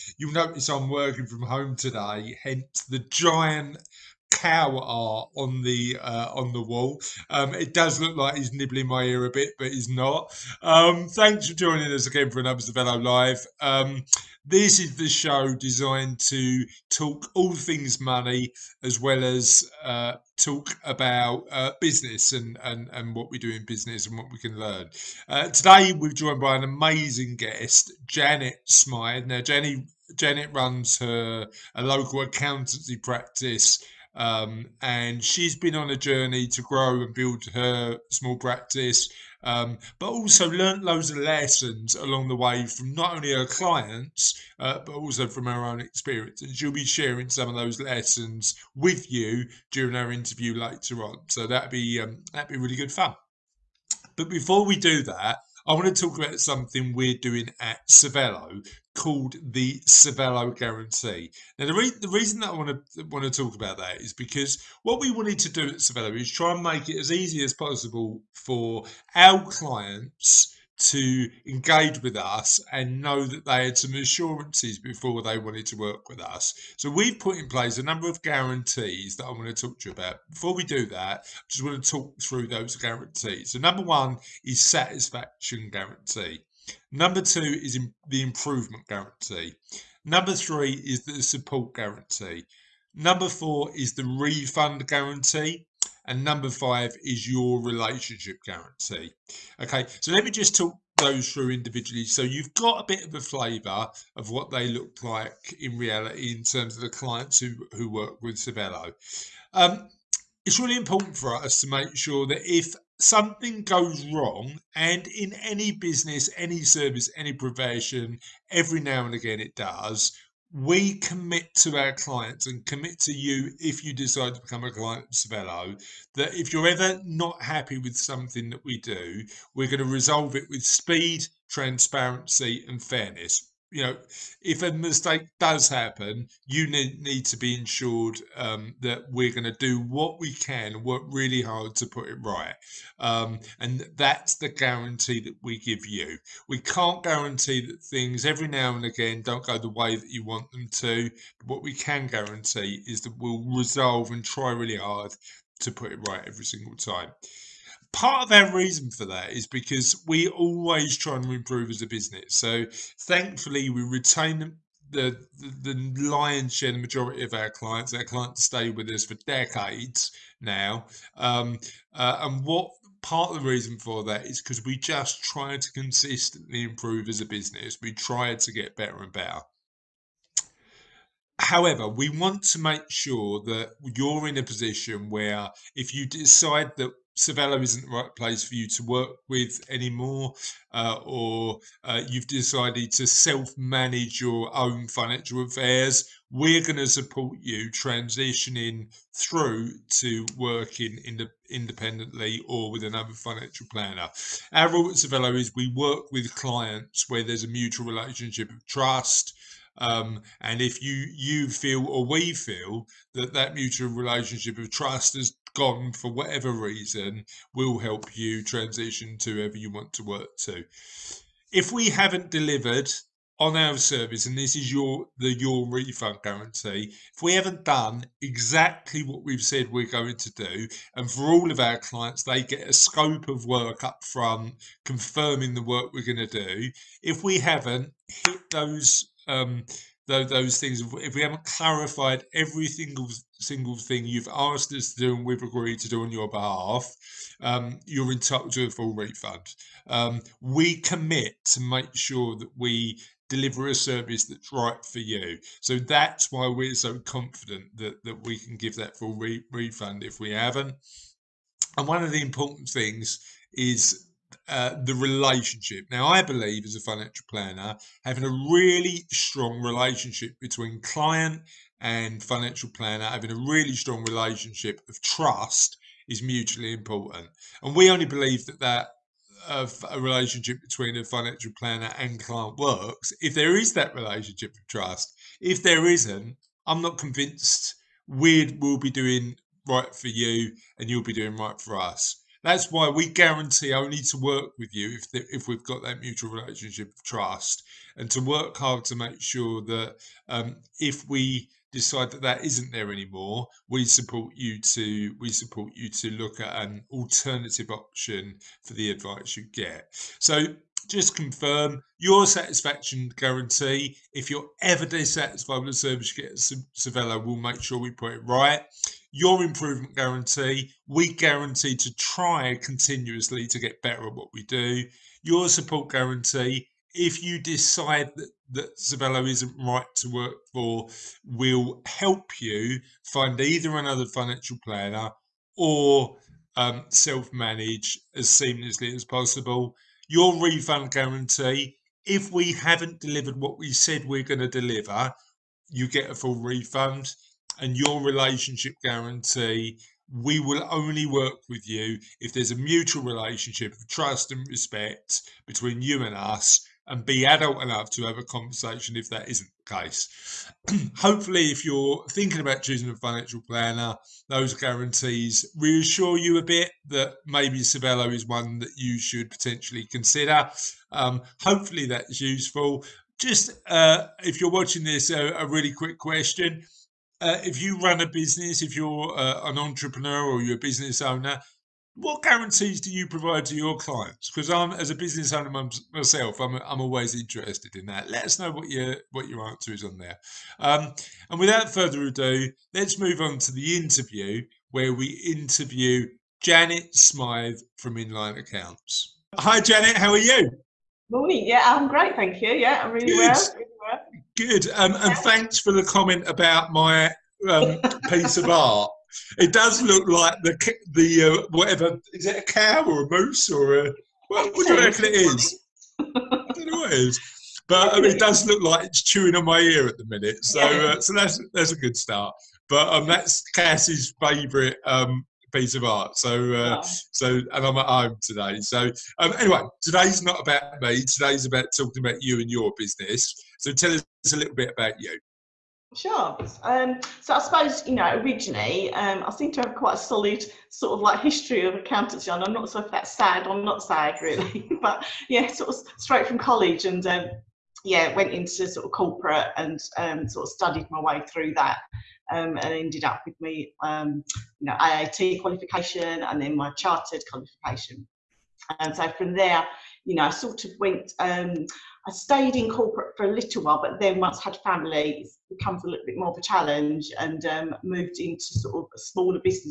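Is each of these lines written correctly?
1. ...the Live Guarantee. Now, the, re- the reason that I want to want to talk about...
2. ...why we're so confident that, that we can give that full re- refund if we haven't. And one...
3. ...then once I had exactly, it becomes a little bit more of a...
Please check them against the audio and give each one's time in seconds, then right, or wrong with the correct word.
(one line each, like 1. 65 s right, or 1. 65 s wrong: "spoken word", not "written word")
1. 59 s wrong: "Cervello", not "Live"
2. 256 s right
3. 463 s wrong: "family", not "exactly".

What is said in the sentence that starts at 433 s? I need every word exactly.
So tell us a little bit about you.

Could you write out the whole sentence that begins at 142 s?
Um, and that's the guarantee that we give you.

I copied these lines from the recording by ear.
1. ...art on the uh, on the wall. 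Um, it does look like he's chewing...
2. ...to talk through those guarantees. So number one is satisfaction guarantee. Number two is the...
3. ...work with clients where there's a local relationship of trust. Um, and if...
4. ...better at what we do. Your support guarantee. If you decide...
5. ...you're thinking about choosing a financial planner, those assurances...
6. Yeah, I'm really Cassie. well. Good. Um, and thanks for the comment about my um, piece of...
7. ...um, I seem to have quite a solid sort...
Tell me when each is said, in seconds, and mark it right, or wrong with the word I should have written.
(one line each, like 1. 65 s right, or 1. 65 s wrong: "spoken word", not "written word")
1. 4 s wrong: "nibbling", not "chewing"
2. 81 s right
3. 205 s wrong: "mutual", not "local"
4. 323 s right
5. 361 s wrong: "guarantees", not "assurances"
6. 402 s wrong: "Good", not "Cassie"
7. 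438 s right.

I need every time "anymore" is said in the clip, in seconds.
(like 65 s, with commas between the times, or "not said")
189 s, 302 s.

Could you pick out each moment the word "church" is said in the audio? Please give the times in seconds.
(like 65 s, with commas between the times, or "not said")
not said.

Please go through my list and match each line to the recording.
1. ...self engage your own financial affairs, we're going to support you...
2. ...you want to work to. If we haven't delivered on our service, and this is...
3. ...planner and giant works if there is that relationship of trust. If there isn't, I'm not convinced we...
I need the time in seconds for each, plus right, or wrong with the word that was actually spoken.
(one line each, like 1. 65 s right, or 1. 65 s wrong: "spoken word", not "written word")
1. 193 s wrong: "manage", not "engage"
2. 219 s right
3. 281 s wrong: "client", not "giant".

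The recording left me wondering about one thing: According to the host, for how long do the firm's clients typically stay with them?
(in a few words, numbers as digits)
decades.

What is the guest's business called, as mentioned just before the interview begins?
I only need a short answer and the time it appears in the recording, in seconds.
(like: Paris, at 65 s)
Inline Accounts, at 397 s.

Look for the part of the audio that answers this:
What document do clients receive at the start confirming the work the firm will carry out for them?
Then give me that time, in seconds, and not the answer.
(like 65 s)
232 s.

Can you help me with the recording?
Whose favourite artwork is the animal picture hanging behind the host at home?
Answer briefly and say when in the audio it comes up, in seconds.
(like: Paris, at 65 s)
Cassie, at 423 s.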